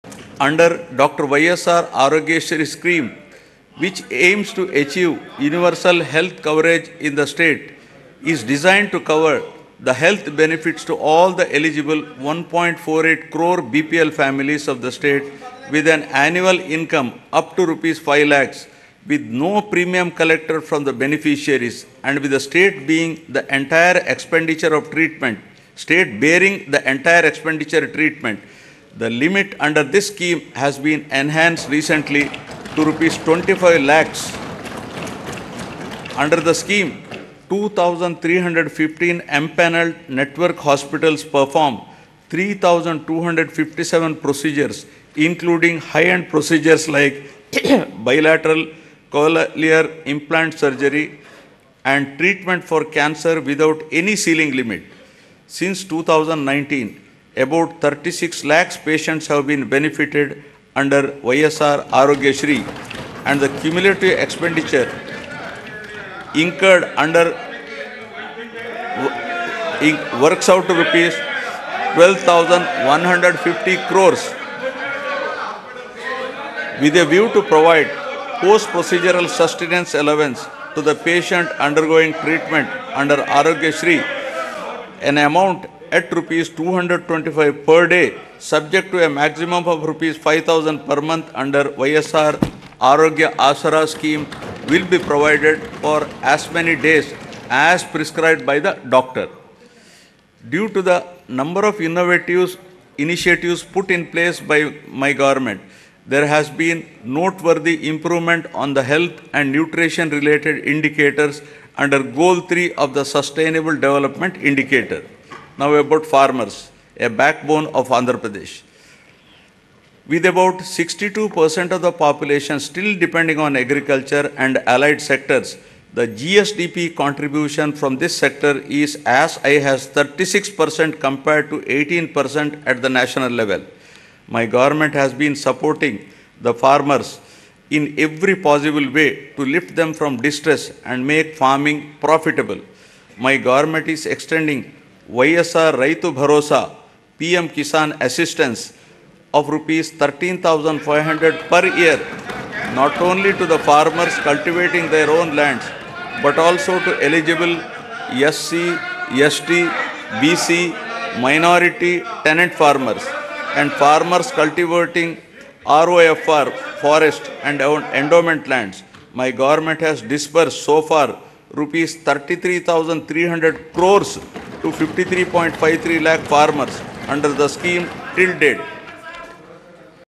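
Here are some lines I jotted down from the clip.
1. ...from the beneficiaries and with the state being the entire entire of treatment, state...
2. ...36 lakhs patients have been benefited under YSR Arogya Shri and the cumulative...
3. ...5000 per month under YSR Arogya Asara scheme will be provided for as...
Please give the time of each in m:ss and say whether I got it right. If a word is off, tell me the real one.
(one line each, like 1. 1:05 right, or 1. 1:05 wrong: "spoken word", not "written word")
1. 0:20 wrong: "expenditure", not "entire"
2. 0:57 right
3. 1:30 right.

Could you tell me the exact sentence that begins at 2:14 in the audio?
My government has been supporting the farmers in every possible way to lift them from distress and make farming profitable.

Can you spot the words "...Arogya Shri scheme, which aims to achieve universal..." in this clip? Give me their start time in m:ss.
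0:02.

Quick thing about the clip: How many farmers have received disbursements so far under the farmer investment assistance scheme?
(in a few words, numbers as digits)
53.53 lakh.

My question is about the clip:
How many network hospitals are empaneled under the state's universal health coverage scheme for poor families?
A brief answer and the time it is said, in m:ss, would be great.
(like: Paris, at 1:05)
2,315, at 0:37.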